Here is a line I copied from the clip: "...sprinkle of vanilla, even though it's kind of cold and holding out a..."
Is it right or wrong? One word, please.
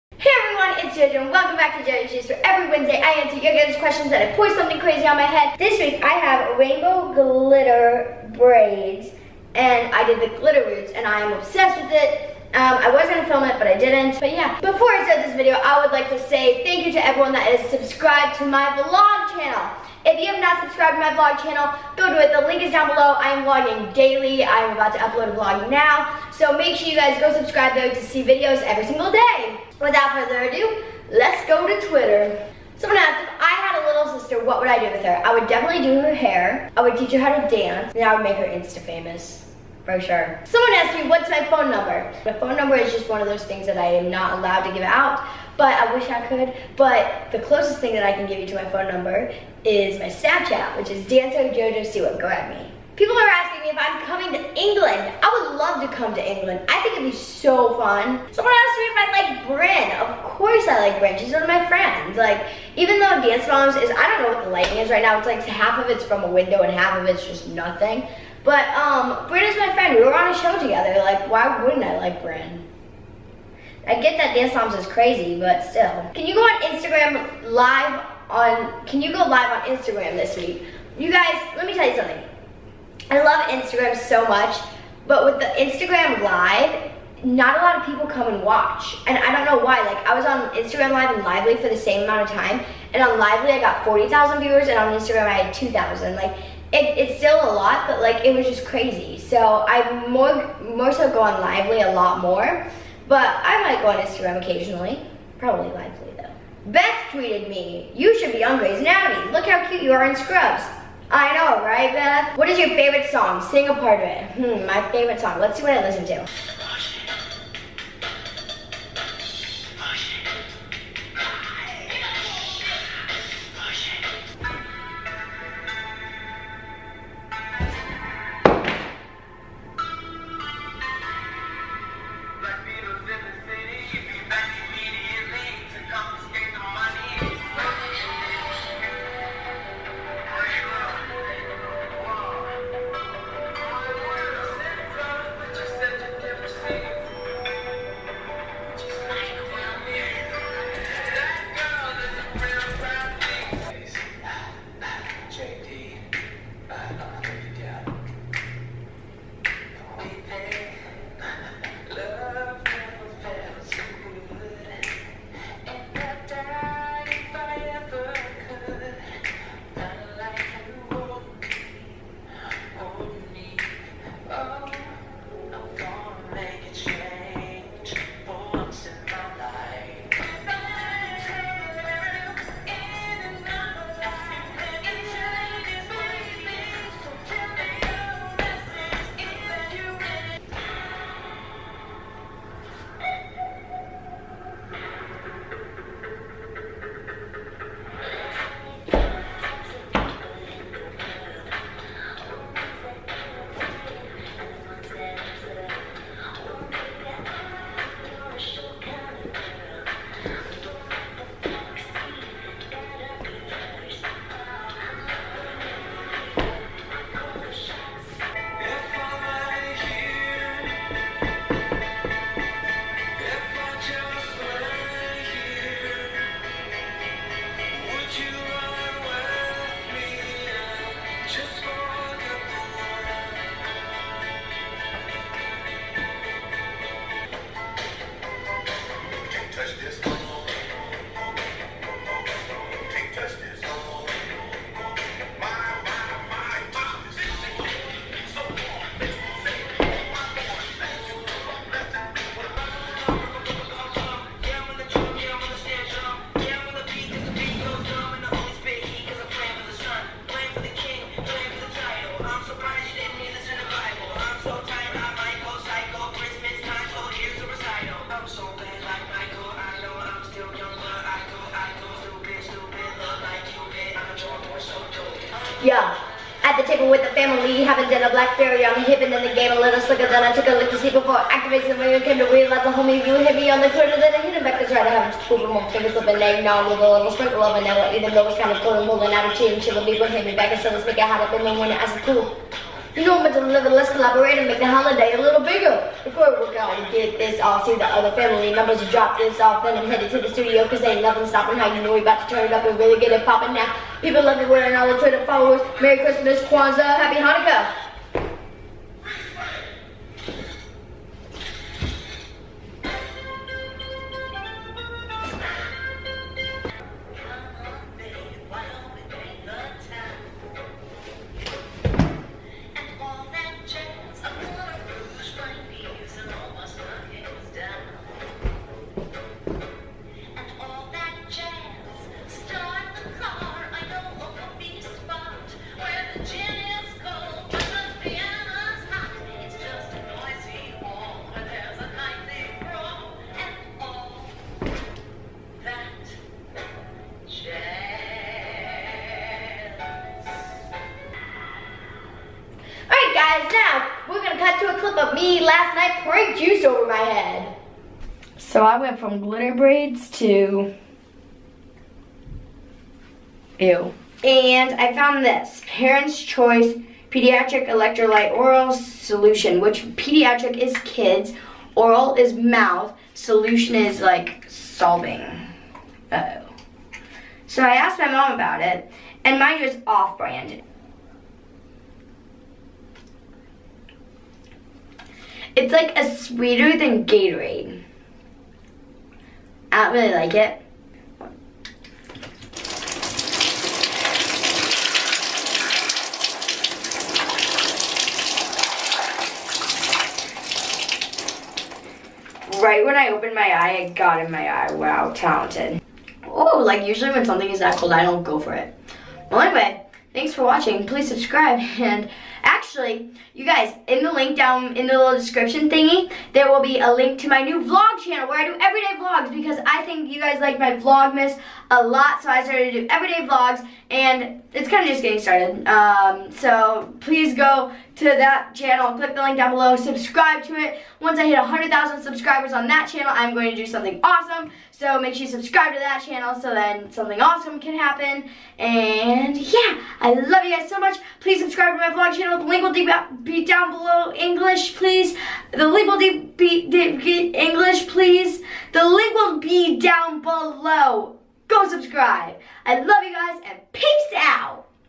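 right.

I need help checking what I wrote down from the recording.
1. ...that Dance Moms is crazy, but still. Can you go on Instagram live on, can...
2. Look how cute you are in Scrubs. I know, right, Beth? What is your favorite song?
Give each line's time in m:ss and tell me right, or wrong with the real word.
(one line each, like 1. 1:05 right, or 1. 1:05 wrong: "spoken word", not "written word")
1. 1:14 right
2. 1:49 right.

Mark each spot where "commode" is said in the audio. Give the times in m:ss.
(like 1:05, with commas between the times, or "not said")
not said.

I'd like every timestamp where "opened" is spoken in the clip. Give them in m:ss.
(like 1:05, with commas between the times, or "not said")
6:43.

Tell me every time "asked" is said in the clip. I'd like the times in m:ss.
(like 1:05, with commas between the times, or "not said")
0:32, 0:40, 0:58, 6:17.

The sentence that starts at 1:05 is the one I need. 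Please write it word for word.
It's like half of it's from a window and half of it's just nothing.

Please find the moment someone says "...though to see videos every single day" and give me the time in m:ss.
0:27.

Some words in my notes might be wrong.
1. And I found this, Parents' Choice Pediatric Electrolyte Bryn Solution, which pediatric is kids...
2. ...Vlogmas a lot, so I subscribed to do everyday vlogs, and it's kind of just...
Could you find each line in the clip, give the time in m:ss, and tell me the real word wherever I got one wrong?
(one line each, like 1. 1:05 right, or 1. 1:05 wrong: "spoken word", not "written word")
1. 6:04 wrong: "Oral", not "Bryn"
2. 7:00 wrong: "started", not "subscribed".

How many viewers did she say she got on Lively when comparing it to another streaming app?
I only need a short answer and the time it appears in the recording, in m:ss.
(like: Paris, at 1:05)
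40,000, at 1:33.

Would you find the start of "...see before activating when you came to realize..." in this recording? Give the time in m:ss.
4:40.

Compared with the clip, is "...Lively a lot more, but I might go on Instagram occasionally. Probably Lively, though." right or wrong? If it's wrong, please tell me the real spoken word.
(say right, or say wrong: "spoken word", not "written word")
right.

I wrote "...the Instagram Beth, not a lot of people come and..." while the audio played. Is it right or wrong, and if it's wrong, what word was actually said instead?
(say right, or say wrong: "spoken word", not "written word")
wrong: "Live", not "Beth".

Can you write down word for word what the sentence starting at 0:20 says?
If you have not subscribed to my vlog channel, go do it.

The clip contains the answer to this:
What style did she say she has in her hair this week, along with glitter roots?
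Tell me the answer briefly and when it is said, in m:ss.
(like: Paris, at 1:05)
Rainbow glitter braids, at 0:06.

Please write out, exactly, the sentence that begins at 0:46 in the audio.
But the closest thing that I can give you to my phone number is my Snapchat, which is Dancer Jojo Siwa.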